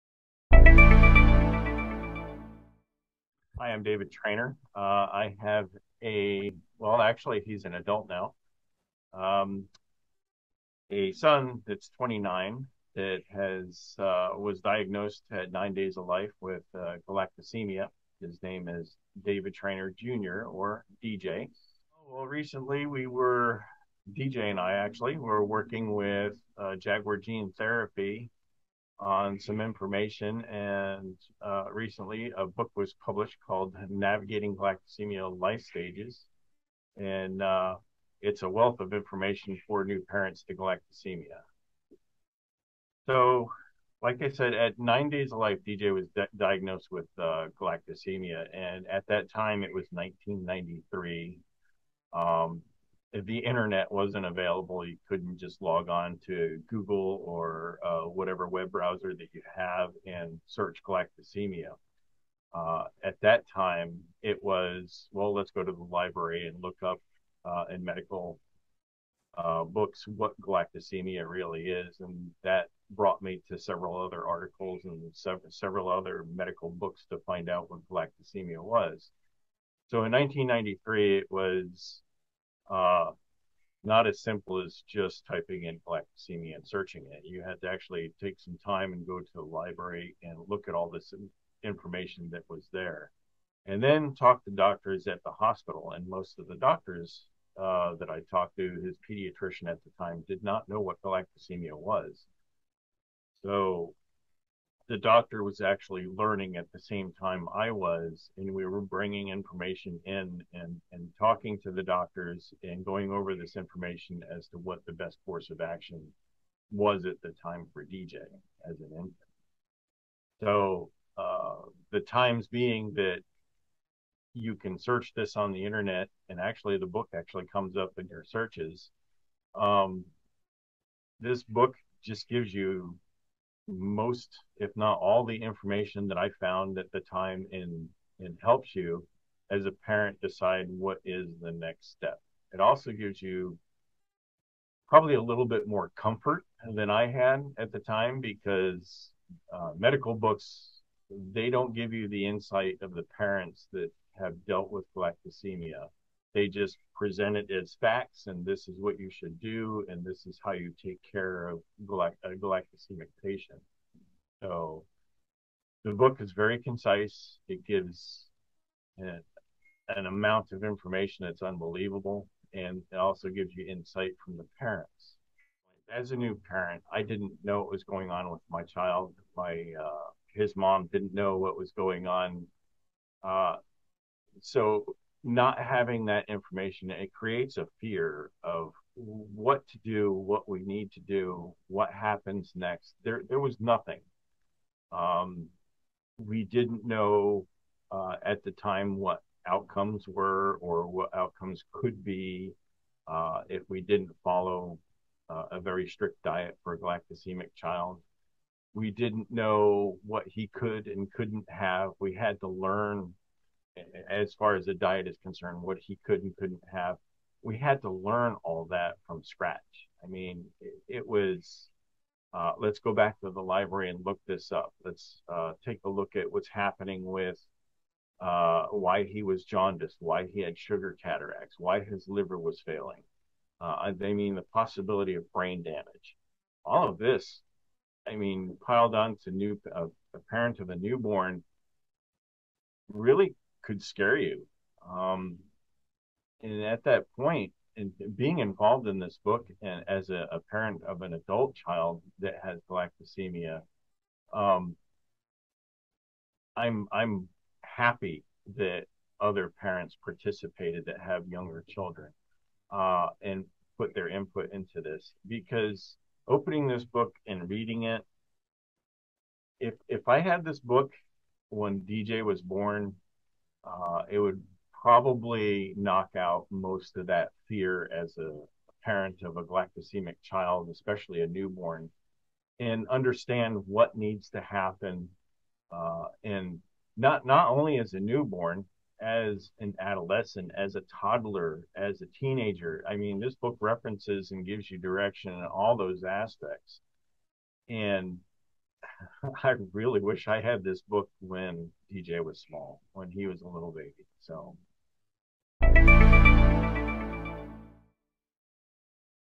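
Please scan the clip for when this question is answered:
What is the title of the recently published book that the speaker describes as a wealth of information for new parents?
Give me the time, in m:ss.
0:33.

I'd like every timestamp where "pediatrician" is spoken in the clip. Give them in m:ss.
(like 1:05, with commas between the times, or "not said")
1:39.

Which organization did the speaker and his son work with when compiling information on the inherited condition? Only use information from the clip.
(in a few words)
Jaguar Gene Therapy.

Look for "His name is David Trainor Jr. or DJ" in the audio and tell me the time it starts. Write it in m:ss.
0:18.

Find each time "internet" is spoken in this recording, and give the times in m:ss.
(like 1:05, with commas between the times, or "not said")
0:53, 2:05.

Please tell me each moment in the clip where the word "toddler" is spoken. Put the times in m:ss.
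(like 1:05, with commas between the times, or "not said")
4:50.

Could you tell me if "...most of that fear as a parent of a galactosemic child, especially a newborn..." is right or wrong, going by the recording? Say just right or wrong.
right.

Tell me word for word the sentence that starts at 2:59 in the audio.
My uh, his mom didn't know what was going on.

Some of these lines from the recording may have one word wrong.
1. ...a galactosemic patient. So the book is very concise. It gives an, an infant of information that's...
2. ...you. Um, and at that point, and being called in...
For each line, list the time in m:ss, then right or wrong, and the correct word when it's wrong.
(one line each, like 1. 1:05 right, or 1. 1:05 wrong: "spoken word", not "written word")
1. 2:41 wrong: "amount", not "infant"
2. 4:04 wrong: "involved", not "called".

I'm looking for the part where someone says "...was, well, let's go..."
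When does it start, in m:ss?
1:04.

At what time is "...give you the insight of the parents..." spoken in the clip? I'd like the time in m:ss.
2:31.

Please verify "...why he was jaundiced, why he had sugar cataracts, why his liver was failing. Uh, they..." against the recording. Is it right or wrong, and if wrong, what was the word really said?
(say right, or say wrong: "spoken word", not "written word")
right.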